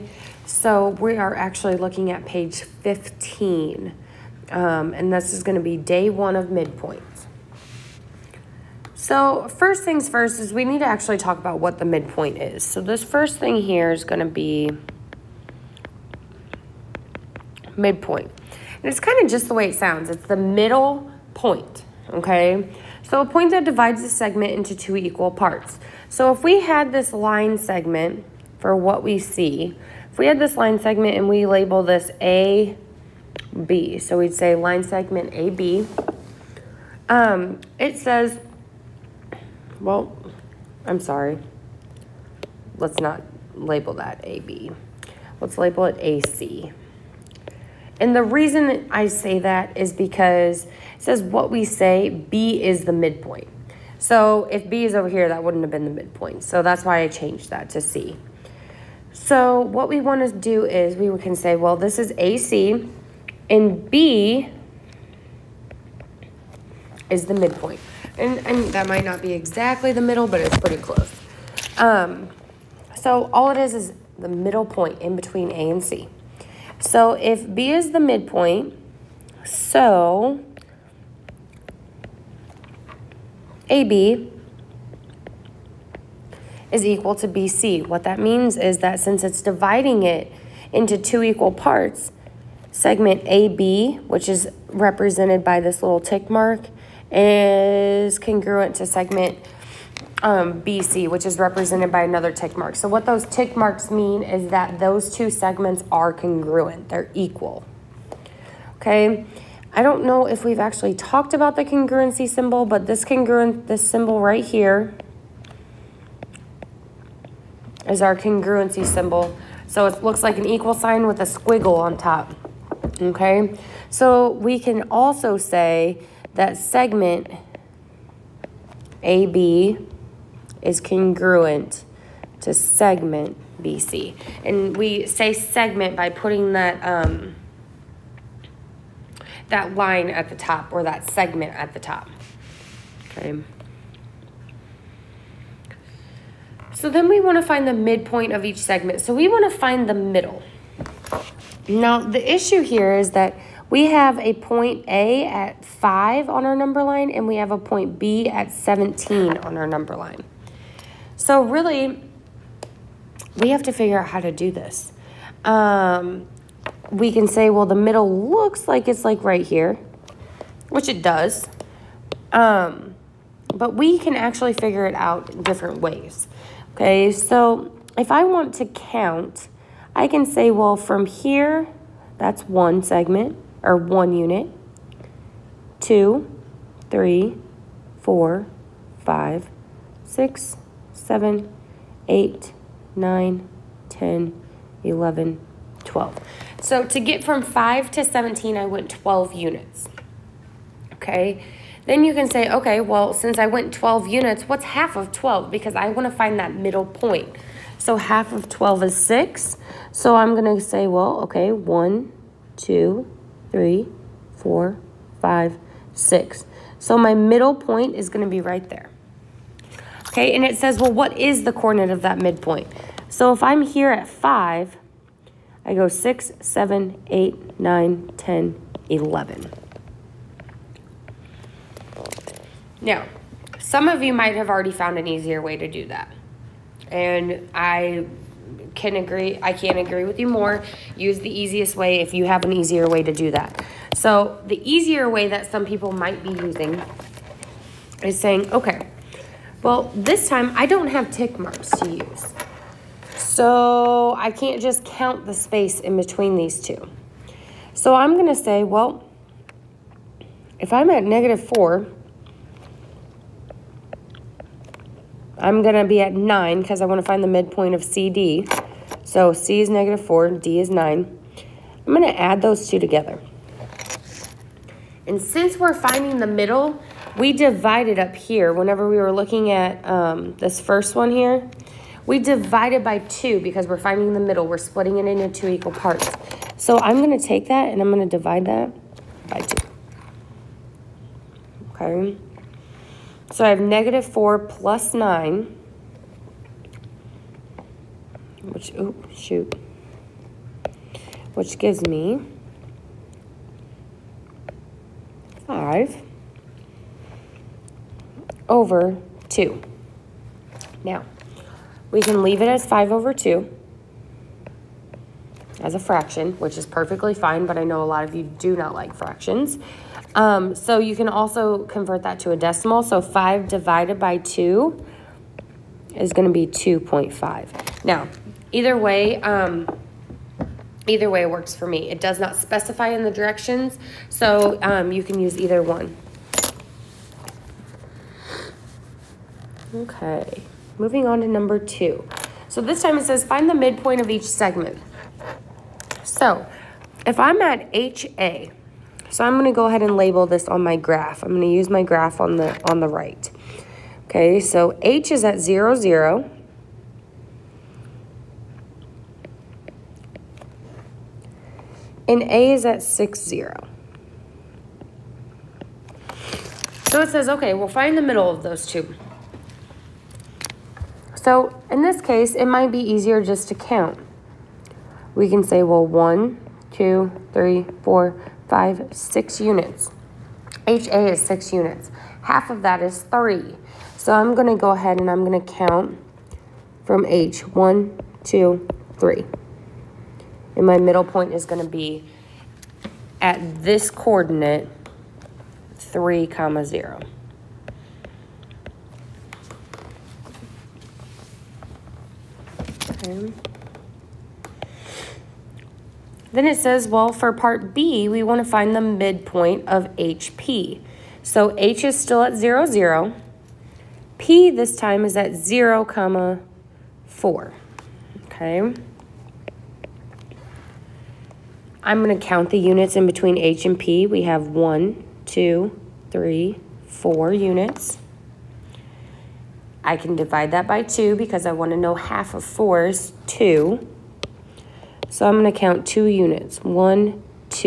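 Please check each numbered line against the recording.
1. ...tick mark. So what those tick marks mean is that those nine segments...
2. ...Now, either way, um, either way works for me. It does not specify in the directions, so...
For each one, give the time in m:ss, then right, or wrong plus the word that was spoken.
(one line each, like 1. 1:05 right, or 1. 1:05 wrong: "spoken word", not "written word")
1. 1:42 wrong: "two", not "nine"
2. 5:27 right.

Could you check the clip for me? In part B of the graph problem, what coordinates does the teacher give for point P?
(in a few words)
(0, 4).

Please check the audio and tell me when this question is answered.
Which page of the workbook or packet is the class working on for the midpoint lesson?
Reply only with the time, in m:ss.
0:02.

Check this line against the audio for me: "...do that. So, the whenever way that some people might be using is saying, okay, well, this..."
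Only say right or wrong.
wrong.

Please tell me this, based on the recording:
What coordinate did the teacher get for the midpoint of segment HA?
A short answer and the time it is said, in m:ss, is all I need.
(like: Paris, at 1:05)
(3, 0), at 6:35.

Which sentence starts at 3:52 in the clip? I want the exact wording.
Now, some of you might have already found an easier way to do that.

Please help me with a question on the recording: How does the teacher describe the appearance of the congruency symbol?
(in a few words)
An equal sign with a squiggle on top.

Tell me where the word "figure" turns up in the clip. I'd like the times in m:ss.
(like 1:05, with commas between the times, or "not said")
2:43, 2:54.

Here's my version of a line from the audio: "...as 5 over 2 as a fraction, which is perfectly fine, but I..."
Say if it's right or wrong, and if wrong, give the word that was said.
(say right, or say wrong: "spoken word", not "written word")
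right.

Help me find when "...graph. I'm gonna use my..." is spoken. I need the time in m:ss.
5:50.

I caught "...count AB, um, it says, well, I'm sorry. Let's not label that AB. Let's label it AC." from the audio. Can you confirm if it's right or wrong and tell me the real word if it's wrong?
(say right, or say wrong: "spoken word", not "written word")
wrong: "segment", not "count".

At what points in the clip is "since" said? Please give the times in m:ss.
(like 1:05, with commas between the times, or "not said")
1:28, 3:23, 4:35.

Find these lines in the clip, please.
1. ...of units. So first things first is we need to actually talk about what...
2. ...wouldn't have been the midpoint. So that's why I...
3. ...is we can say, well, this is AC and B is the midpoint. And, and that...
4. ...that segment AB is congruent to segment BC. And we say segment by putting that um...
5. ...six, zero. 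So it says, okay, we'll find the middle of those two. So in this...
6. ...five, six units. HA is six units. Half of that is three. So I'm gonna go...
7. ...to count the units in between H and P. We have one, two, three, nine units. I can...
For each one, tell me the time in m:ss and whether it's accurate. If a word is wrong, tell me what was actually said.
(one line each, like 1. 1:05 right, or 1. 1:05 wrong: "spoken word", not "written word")
1. 0:06 wrong: "midpoints", not "units"
2. 0:55 right
3. 1:00 right
4. 2:06 right
5. 6:02 right
6. 6:18 right
7. 7:02 wrong: "four", not "nine".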